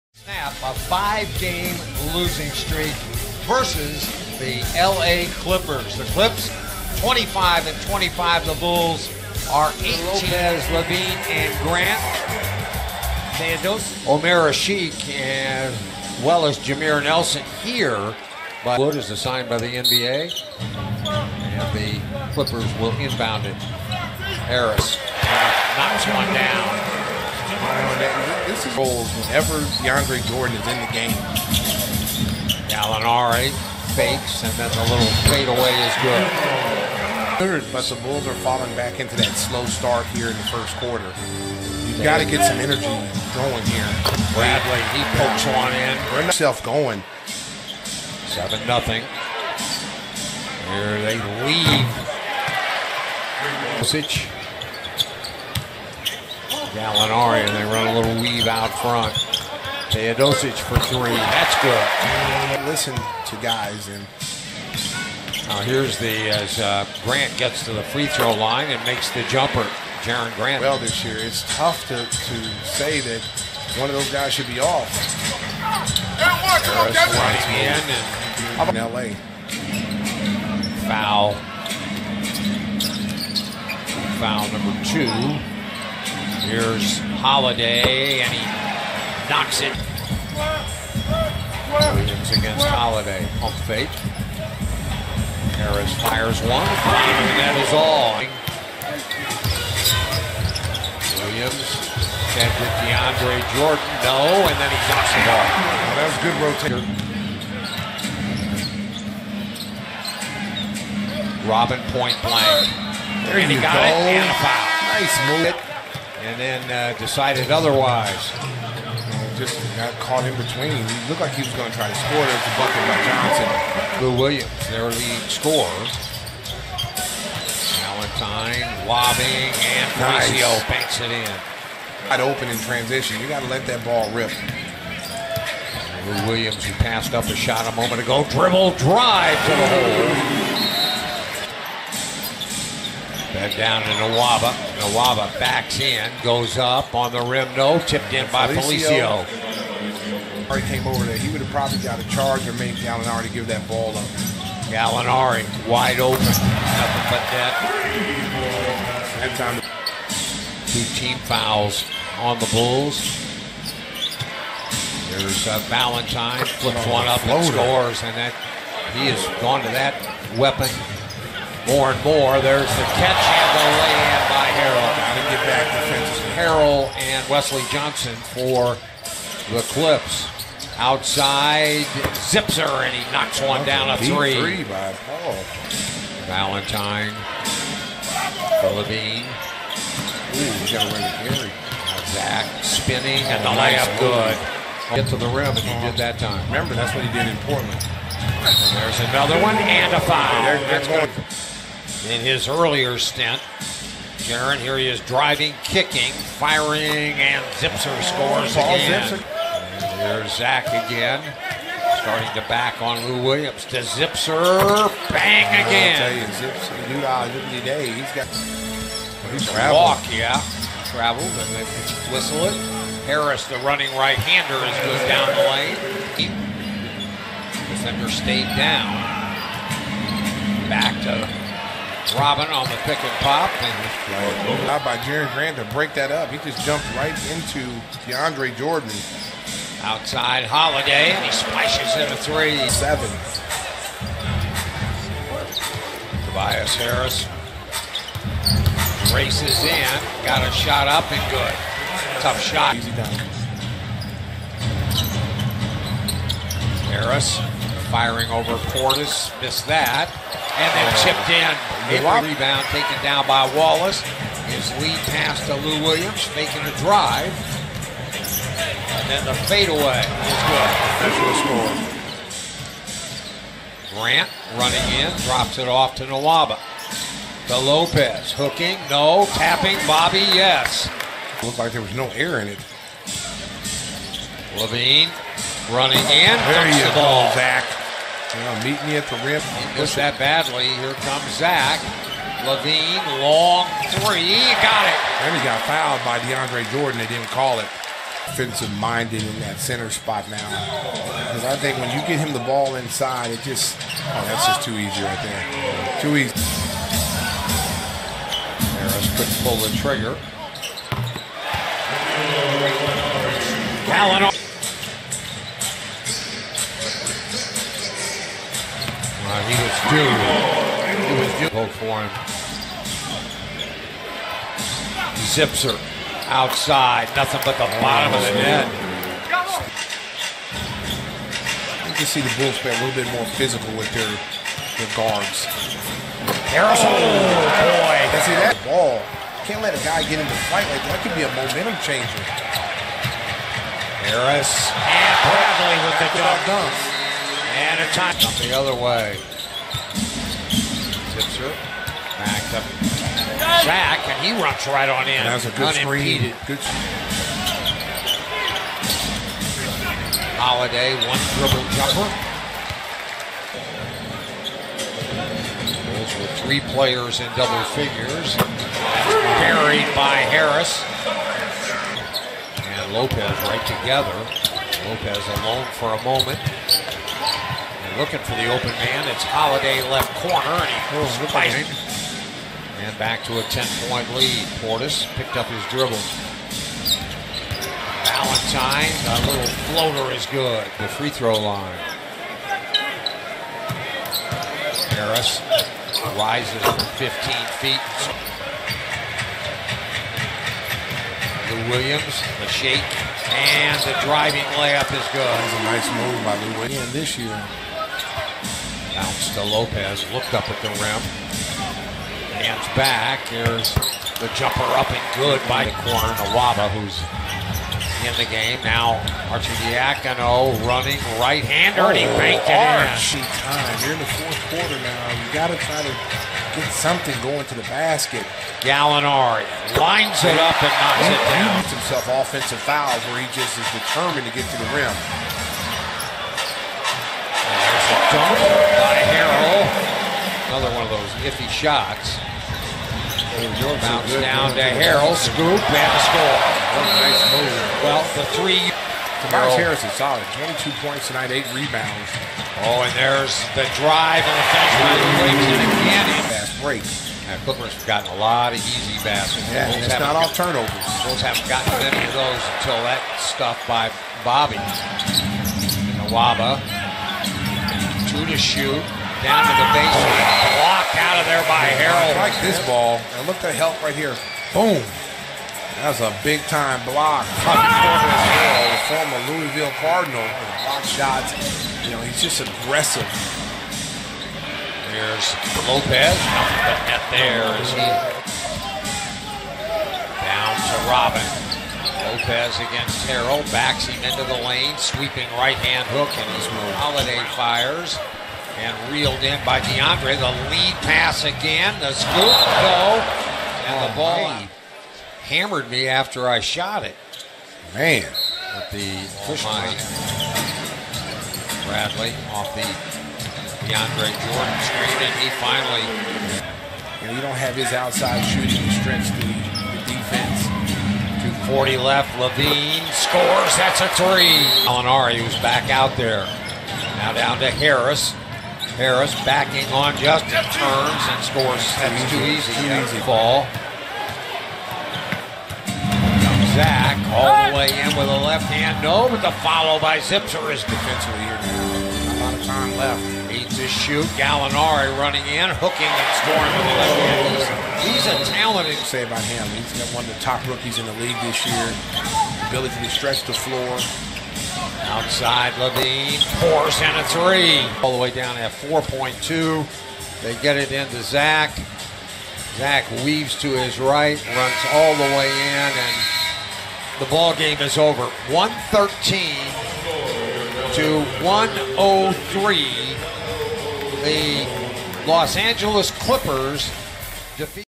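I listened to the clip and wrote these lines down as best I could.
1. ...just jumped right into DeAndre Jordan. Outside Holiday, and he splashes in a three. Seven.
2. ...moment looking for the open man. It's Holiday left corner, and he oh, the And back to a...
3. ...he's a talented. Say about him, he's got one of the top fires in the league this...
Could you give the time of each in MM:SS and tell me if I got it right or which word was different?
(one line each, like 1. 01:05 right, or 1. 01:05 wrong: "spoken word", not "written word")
1. 03:56 right
2. 06:16 right
3. 09:08 wrong: "rookies", not "fires".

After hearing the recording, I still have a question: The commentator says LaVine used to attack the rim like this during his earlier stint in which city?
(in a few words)
Portland.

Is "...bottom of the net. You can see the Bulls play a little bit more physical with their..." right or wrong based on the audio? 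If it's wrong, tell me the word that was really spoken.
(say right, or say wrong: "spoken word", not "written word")
right.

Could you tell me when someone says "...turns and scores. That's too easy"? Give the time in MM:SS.
08:50.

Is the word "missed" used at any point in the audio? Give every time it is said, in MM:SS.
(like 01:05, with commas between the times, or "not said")
04:19, 04:49.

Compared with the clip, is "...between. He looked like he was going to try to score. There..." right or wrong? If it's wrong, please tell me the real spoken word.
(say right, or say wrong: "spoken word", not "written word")
right.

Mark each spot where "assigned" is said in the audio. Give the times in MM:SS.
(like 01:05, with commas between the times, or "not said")
00:19.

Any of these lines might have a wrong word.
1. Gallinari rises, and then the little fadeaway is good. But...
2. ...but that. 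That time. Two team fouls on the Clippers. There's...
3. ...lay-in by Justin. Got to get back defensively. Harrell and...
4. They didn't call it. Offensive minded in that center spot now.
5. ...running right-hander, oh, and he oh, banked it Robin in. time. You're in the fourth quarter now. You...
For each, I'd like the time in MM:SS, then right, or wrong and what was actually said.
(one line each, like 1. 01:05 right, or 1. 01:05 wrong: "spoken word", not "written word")
1. 00:32 wrong: "fakes", not "rises"
2. 02:37 wrong: "Bulls", not "Clippers"
3. 02:53 wrong: "Harrell", not "Justin"
4. 04:56 right
5. 07:00 wrong: "Archie", not "Robin".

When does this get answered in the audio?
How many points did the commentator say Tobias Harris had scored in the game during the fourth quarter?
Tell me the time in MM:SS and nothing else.
07:30.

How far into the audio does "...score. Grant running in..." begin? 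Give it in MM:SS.
04:32.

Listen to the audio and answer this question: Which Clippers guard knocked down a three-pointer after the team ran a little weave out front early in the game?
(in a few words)
Teodosic.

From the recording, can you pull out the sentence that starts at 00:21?
And the Clippers will inbound it.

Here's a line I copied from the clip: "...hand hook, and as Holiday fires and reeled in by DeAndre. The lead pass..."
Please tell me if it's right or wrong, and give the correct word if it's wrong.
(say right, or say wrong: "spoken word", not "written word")
right.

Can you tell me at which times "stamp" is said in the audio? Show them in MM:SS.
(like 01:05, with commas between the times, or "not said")
not said.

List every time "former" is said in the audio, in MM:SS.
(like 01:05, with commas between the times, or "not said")
07:58.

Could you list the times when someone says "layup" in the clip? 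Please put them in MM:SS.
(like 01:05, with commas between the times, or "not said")
03:13, 06:44.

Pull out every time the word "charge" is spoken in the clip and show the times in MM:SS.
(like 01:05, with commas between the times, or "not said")
02:32.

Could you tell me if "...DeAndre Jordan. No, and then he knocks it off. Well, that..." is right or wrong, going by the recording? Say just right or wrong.
right.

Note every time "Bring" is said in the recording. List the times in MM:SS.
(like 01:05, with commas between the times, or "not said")
00:46.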